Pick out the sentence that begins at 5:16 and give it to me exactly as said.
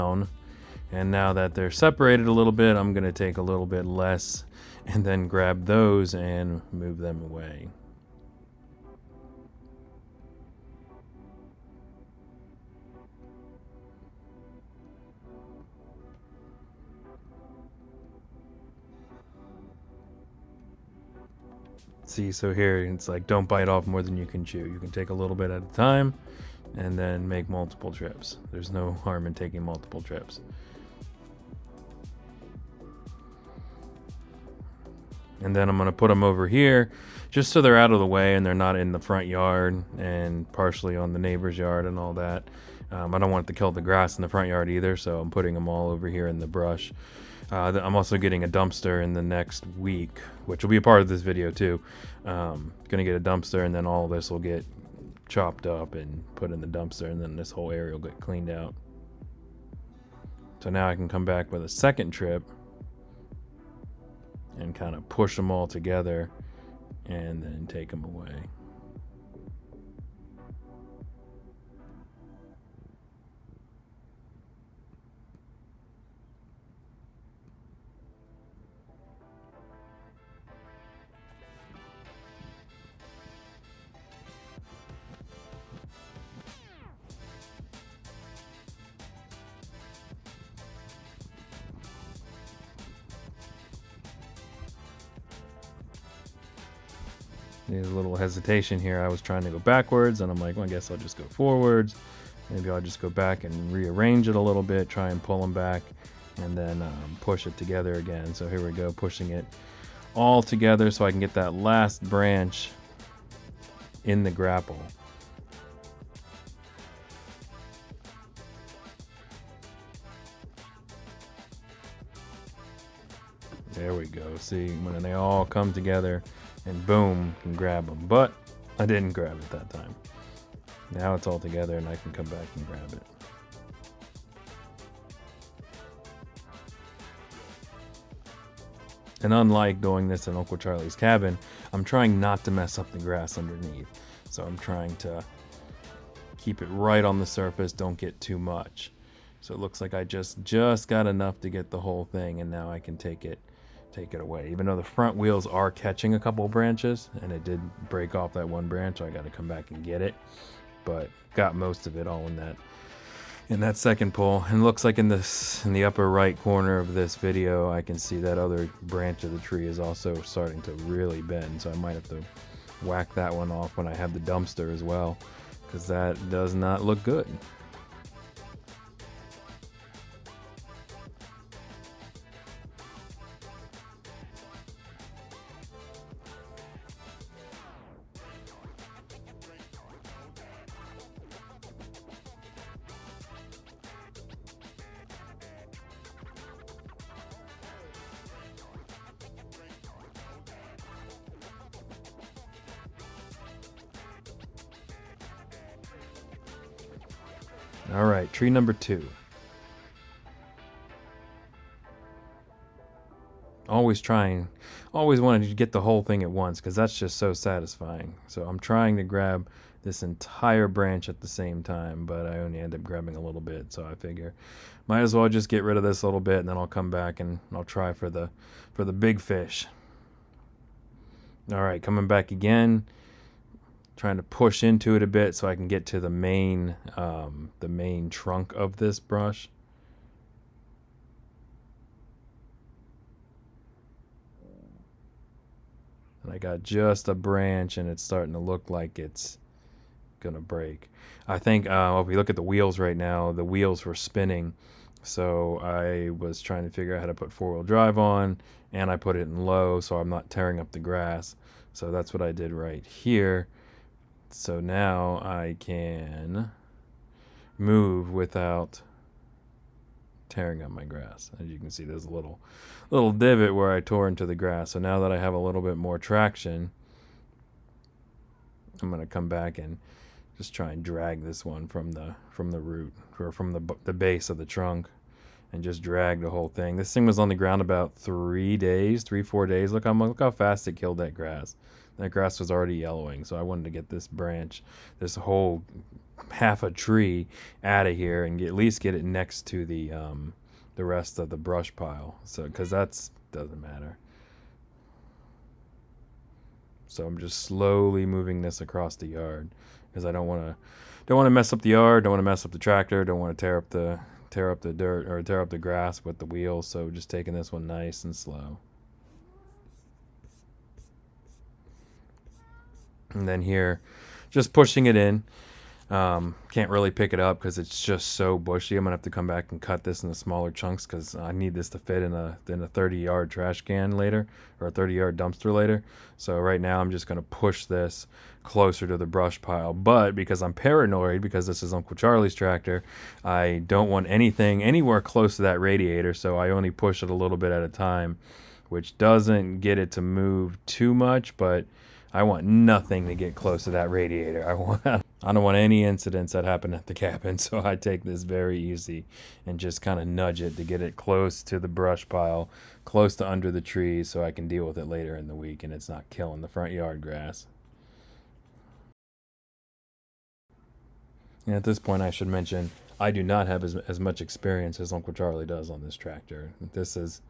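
So just taking this one nice and slow.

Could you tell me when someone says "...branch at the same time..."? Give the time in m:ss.
3:40.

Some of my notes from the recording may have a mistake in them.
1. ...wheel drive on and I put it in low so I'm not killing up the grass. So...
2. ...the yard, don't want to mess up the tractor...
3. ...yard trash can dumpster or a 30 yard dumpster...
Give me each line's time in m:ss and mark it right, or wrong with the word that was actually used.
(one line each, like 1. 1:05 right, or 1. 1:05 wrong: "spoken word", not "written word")
1. 4:17 wrong: "tearing", not "killing"
2. 5:11 right
3. 5:32 wrong: "later", not "dumpster".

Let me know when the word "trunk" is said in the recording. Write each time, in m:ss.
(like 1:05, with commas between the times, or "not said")
3:58, 4:44.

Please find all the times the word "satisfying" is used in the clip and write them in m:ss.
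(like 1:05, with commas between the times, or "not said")
3:37.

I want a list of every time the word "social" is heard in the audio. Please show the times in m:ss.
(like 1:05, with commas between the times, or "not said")
not said.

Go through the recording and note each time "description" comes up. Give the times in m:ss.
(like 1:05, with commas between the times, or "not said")
not said.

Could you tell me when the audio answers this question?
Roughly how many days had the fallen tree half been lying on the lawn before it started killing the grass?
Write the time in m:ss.
4:49.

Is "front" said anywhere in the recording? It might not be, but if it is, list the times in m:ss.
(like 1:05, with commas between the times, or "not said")
0:38, 0:44, 2:34, 6:06.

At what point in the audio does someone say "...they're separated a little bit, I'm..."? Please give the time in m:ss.
0:01.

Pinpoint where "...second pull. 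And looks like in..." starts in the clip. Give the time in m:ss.
2:43.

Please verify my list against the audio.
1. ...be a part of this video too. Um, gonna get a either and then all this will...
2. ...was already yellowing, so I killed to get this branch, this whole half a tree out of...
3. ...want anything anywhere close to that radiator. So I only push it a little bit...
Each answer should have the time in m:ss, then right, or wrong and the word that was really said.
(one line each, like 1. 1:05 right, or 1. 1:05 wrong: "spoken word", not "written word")
1. 0:50 wrong: "dumpster", not "either"
2. 4:52 wrong: "wanted", not "killed"
3. 5:43 right.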